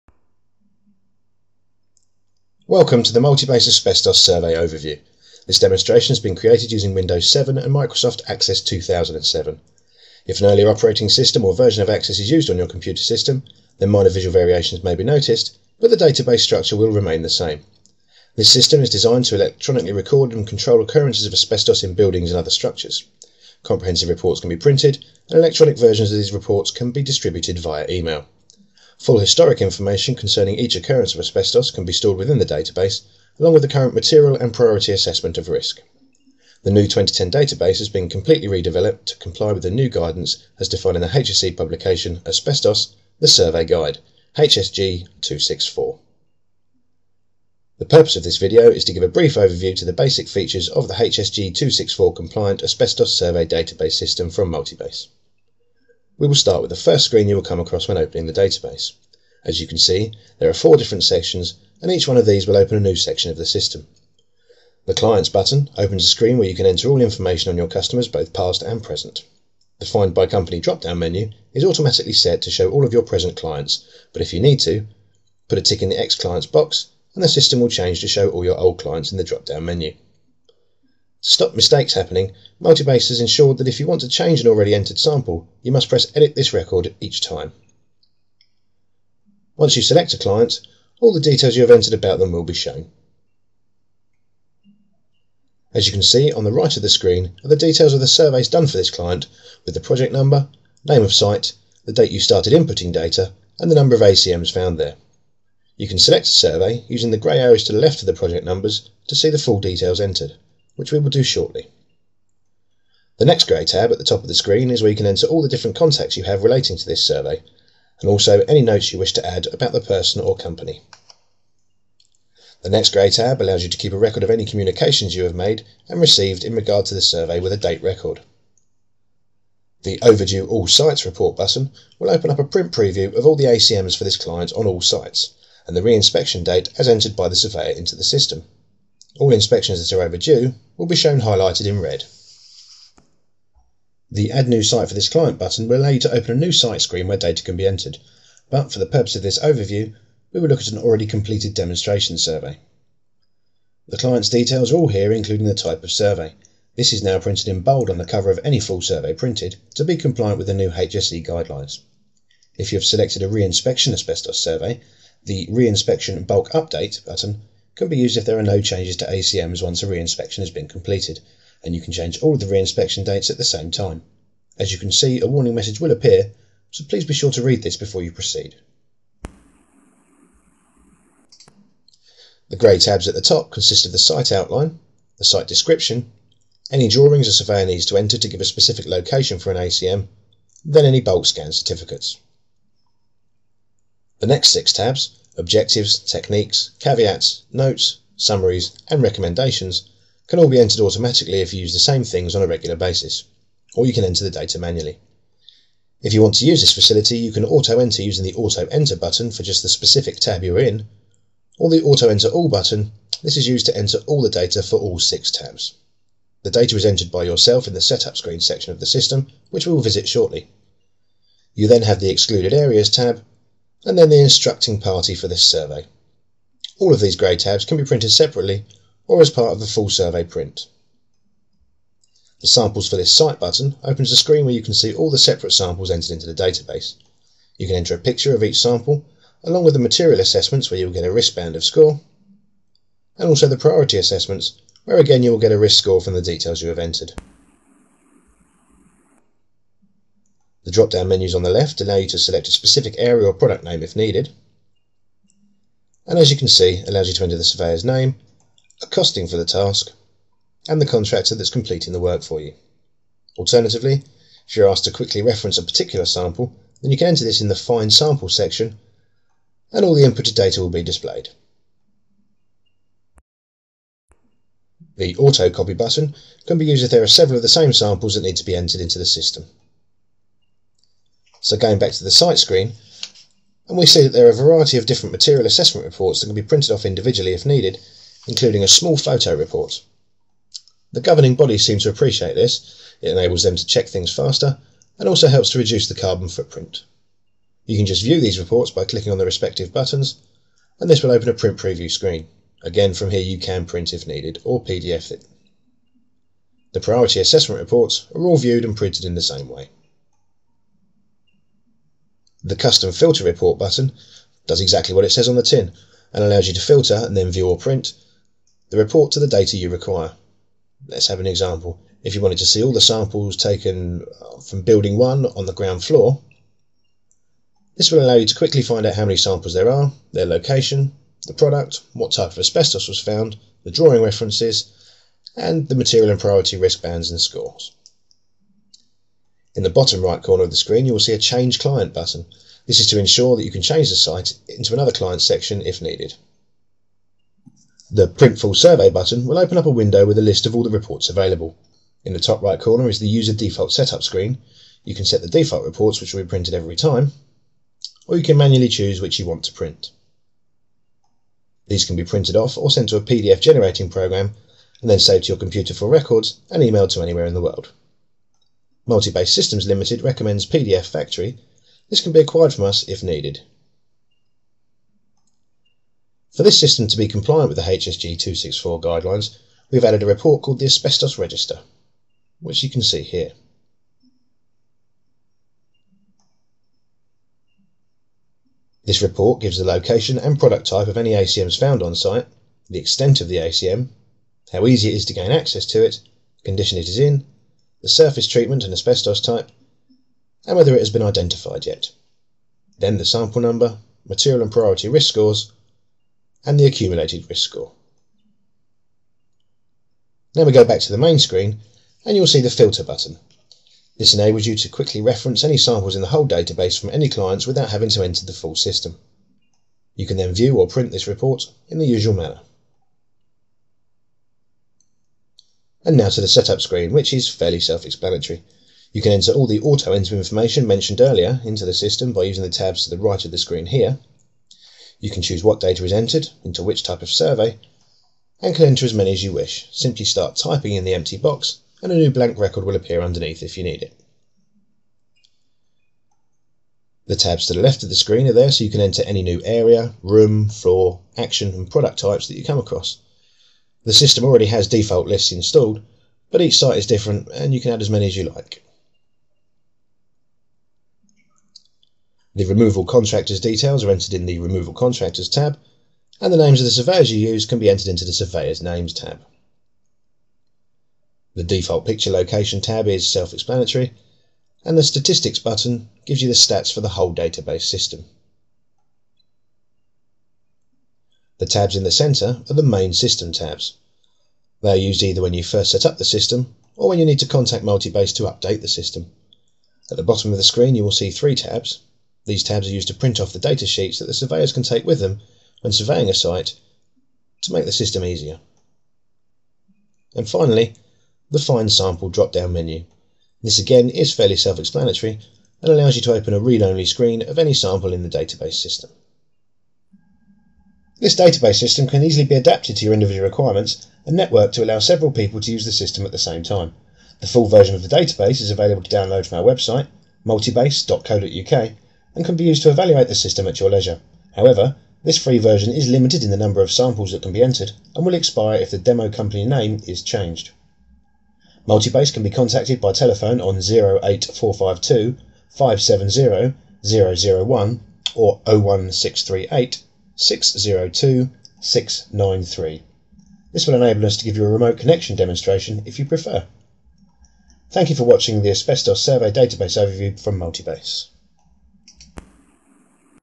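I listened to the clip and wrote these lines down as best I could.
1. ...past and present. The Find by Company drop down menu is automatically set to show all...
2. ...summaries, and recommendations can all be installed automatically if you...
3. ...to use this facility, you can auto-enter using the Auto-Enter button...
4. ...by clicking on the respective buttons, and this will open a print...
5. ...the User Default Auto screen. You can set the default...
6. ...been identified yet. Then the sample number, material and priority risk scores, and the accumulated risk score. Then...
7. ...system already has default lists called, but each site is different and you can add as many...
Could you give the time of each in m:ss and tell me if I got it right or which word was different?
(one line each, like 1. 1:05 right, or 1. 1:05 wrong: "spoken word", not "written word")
1. 1:08 right
2. 3:18 wrong: "entered", not "installed"
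3. 3:26 right
4. 4:58 right
5. 5:52 wrong: "Setup", not "Auto"
6. 6:40 right
7. 7:33 wrong: "installed", not "called".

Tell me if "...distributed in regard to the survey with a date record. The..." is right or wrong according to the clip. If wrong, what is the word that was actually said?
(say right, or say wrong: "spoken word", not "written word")
wrong: "received", not "distributed".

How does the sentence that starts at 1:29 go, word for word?
Once you select a client, all the details you have entered about them will be shown.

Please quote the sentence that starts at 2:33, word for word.
The client's details are all here, including the type of survey.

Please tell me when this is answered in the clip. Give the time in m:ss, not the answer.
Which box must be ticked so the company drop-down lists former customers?
1:15.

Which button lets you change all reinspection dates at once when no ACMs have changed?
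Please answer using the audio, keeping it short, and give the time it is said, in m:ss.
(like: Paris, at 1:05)
Reinspection Bulk Update, at 2:45.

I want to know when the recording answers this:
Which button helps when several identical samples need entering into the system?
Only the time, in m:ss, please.
4:35.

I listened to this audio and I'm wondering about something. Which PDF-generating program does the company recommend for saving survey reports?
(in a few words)
PDF Factory.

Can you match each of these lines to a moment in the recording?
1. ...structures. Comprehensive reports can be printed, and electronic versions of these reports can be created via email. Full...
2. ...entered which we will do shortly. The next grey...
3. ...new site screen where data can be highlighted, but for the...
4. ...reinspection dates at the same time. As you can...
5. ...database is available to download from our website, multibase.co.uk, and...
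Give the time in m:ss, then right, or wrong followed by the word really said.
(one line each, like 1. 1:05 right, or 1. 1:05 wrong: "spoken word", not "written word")
1. 0:22 wrong: "distributed", not "created"
2. 1:50 right
3. 2:26 wrong: "entered", not "highlighted"
4. 2:52 right
5. 8:37 right.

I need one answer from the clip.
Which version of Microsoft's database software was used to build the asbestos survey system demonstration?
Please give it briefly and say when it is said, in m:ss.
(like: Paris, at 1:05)
Access 2007, at 0:07.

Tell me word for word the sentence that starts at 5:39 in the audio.
In the bottom right corner of the screen, you will see a Change Client button.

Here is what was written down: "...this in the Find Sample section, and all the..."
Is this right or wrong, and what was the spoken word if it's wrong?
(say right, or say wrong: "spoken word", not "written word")
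right.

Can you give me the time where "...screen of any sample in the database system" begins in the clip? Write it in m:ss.
8:26.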